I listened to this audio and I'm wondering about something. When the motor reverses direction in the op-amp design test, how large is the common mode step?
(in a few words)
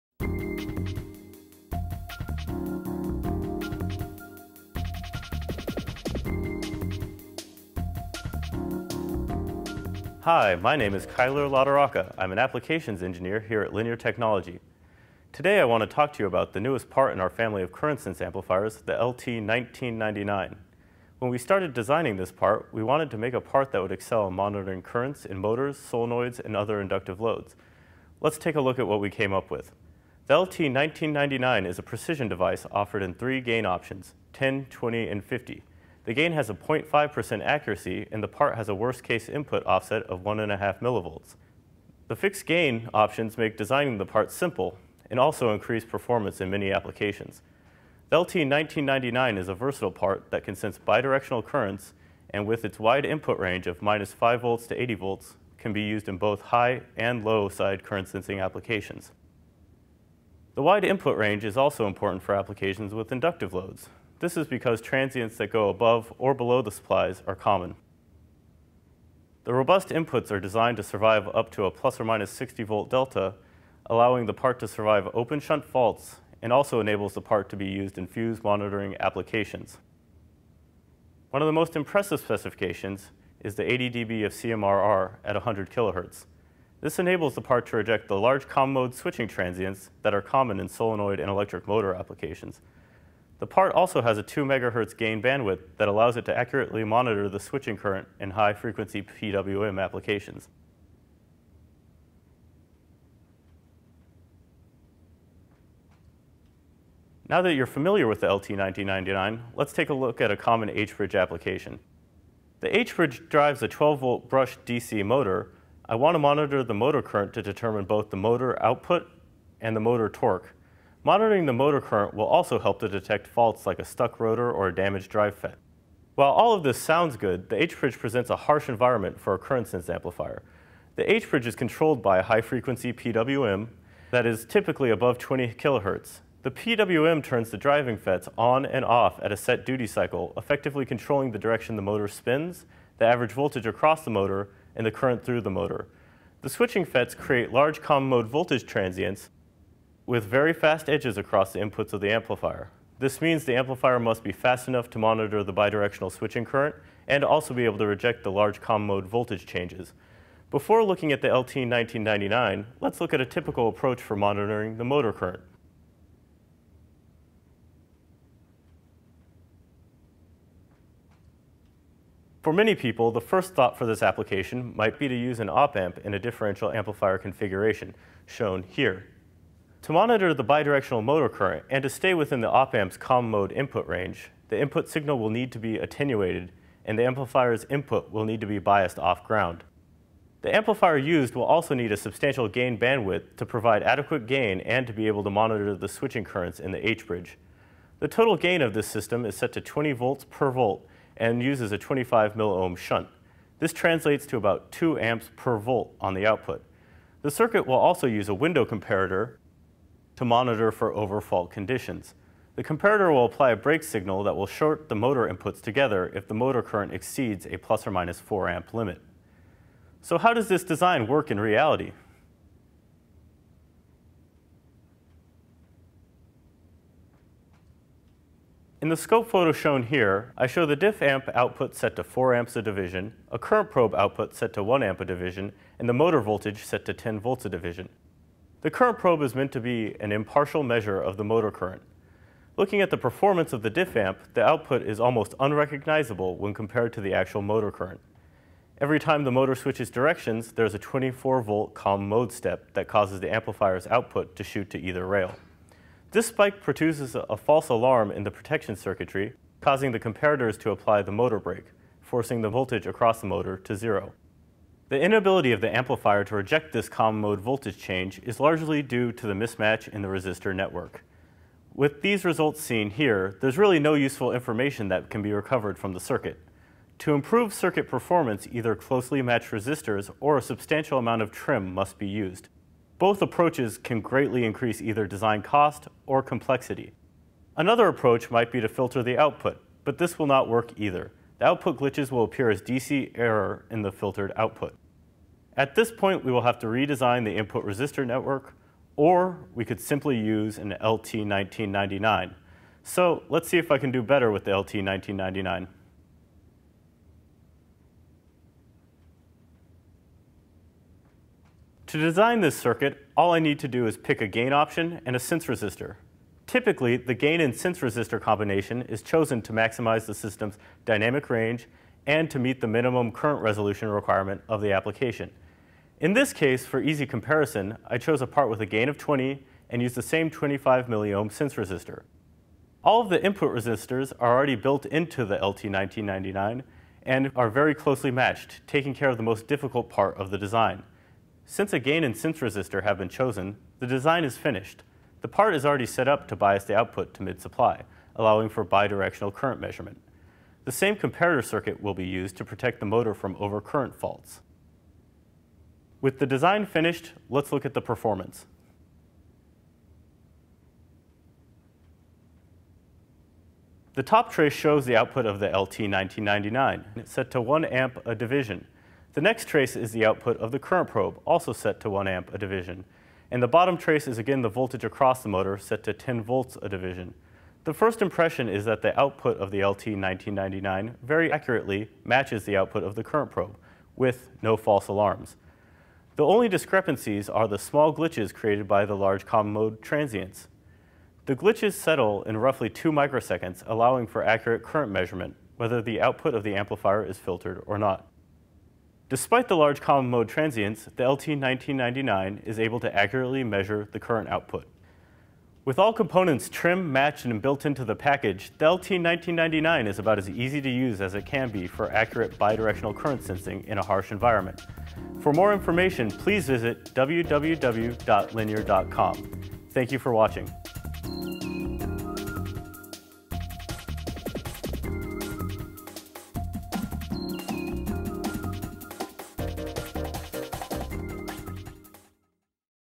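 24 volts.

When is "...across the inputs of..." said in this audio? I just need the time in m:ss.
2:31.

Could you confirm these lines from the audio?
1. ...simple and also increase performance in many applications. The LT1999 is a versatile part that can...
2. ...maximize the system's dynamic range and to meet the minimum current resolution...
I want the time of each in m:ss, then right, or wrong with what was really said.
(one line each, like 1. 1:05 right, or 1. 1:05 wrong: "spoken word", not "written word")
1. 0:44 right
2. 5:19 right.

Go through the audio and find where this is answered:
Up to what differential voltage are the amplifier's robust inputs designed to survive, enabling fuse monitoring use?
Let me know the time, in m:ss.
1:11.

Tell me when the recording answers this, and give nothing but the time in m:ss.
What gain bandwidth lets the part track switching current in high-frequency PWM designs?
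1:34.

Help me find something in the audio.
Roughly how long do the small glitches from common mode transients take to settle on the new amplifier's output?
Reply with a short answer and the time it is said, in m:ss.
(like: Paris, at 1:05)
2 microseconds, at 6:32.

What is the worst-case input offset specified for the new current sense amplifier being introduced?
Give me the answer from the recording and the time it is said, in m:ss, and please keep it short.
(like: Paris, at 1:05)
1.5 millivolts, at 0:40.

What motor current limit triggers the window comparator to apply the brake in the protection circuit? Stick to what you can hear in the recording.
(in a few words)
±4 amps.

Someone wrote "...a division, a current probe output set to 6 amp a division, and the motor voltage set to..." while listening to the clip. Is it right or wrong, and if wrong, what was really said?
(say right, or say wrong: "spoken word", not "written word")
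wrong: "1", not "6".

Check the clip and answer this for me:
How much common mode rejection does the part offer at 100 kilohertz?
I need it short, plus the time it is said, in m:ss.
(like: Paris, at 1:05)
80 dB, at 1:23.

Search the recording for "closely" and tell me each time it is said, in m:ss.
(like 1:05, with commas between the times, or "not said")
4:38, 5:37.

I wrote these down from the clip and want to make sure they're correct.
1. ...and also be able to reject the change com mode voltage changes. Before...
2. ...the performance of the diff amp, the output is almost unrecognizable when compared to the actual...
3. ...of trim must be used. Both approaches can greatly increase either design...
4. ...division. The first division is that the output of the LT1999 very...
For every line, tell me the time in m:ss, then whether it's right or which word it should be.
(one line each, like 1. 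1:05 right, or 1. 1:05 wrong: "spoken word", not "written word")
1. 2:37 wrong: "large", not "change"
2. 4:02 right
3. 4:41 right
4. 6:16 wrong: "impression", not "division".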